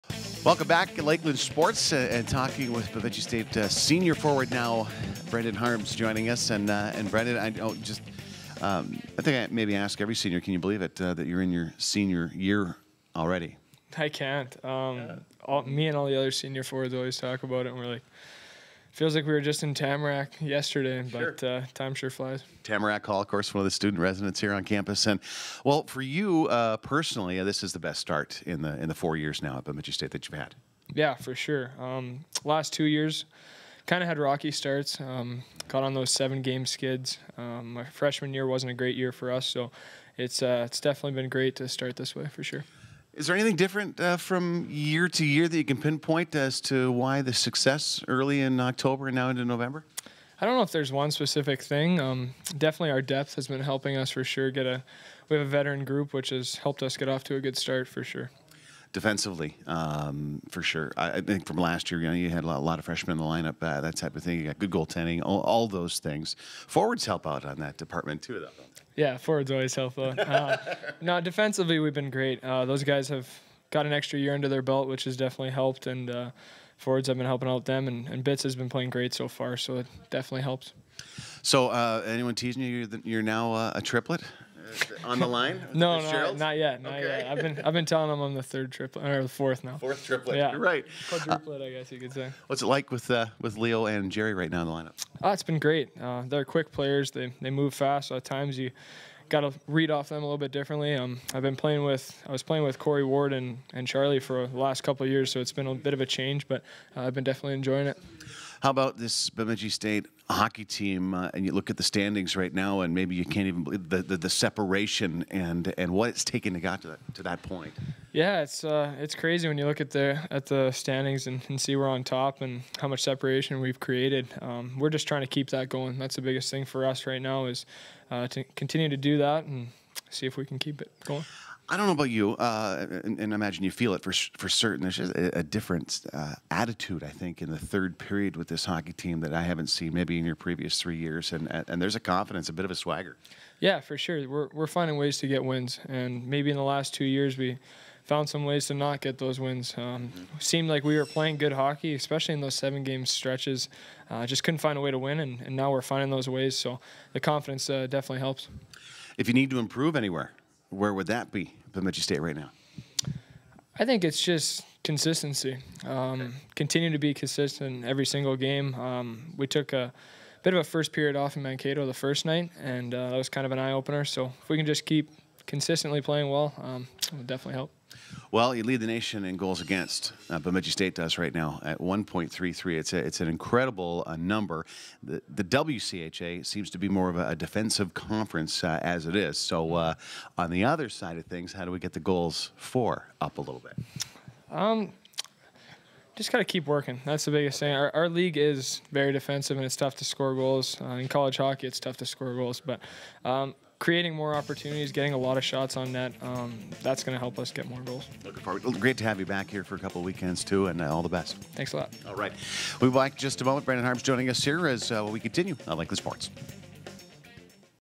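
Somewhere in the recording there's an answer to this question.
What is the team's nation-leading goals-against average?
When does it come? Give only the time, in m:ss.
3:01.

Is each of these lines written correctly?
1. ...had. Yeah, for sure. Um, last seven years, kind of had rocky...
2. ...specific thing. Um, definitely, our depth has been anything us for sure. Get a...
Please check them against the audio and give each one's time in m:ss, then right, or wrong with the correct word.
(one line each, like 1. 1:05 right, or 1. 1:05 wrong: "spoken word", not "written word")
1. 0:30 wrong: "two", not "seven"
2. 0:51 wrong: "helping", not "anything".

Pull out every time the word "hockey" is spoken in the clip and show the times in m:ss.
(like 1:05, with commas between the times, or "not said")
1:50, 2:18, 2:31, 3:21.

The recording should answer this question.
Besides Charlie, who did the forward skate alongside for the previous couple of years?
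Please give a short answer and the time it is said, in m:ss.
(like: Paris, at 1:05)
Corey Ward, at 1:42.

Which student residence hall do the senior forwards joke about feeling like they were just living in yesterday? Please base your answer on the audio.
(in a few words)
Tamarack Hall.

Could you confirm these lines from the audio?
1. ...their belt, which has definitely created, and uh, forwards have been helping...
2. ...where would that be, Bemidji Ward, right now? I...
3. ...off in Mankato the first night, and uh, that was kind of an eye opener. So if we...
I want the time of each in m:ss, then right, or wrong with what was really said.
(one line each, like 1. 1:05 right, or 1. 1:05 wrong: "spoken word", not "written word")
1. 1:14 wrong: "helped", not "created"
2. 2:40 wrong: "State", not "Ward"
3. 2:51 right.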